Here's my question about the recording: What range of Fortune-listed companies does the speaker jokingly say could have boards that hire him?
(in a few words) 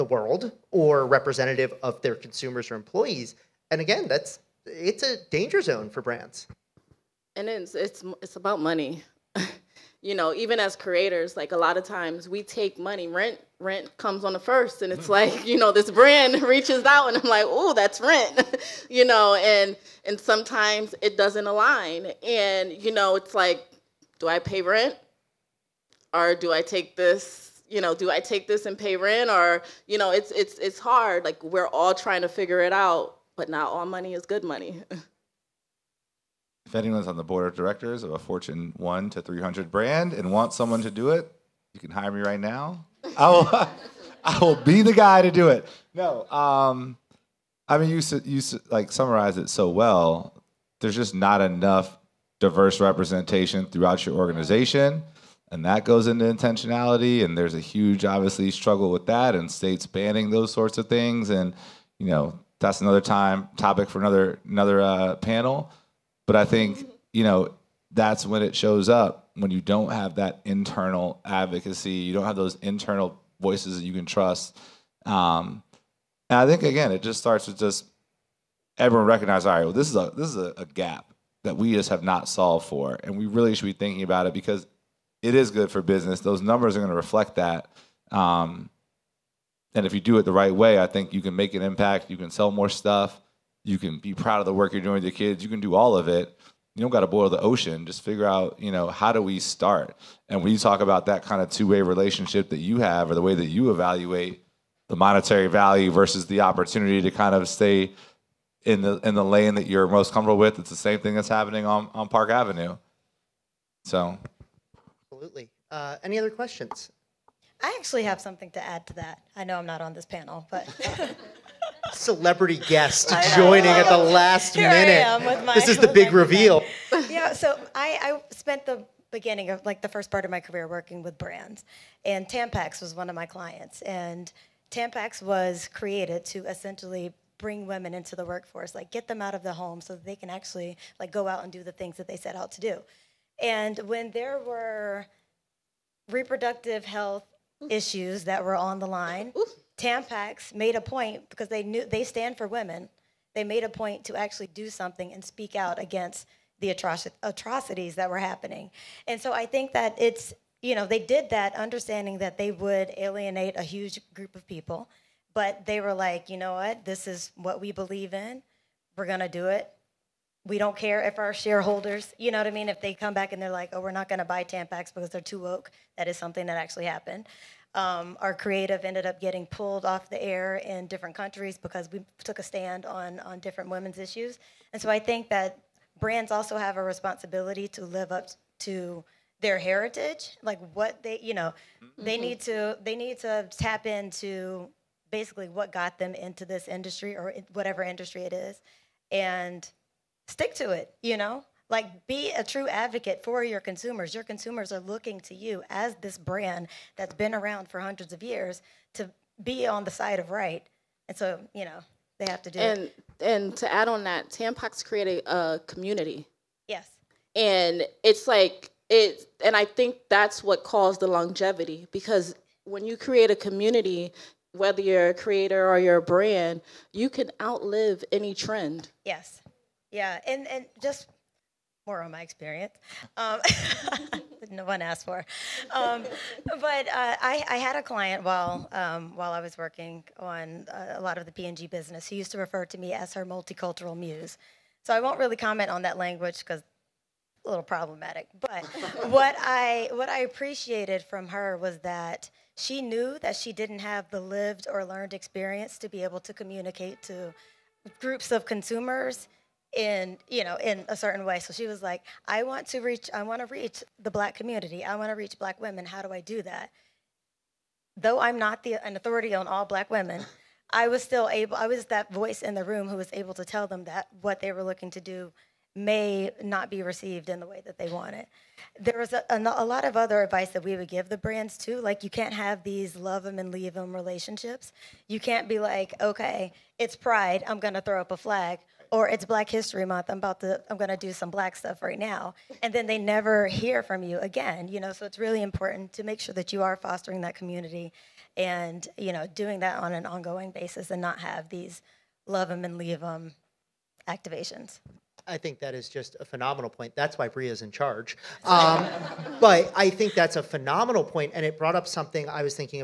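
Fortune 1 to 300.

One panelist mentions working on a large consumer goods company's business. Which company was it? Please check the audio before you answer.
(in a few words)
P&G.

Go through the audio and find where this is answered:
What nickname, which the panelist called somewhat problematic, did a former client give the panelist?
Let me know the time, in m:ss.
4:03.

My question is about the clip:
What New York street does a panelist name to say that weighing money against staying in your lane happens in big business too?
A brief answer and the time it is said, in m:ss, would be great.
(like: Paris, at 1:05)
Park Avenue, at 1:52.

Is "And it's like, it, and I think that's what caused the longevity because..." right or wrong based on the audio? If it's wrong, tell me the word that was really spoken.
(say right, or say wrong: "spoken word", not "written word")
right.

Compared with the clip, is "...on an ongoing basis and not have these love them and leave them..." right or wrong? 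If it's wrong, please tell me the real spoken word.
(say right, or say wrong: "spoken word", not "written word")
right.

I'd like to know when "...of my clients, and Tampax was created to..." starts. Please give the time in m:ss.
2:13.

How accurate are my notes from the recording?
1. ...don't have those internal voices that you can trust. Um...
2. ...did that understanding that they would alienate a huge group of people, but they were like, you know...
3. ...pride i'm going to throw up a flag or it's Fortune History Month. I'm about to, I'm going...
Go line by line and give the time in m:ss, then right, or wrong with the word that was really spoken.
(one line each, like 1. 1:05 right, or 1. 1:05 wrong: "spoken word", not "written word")
1. 1:12 right
2. 2:40 right
3. 4:46 wrong: "Black", not "Fortune".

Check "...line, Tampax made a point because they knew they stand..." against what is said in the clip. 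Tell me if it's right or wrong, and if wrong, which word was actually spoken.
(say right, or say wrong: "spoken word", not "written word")
right.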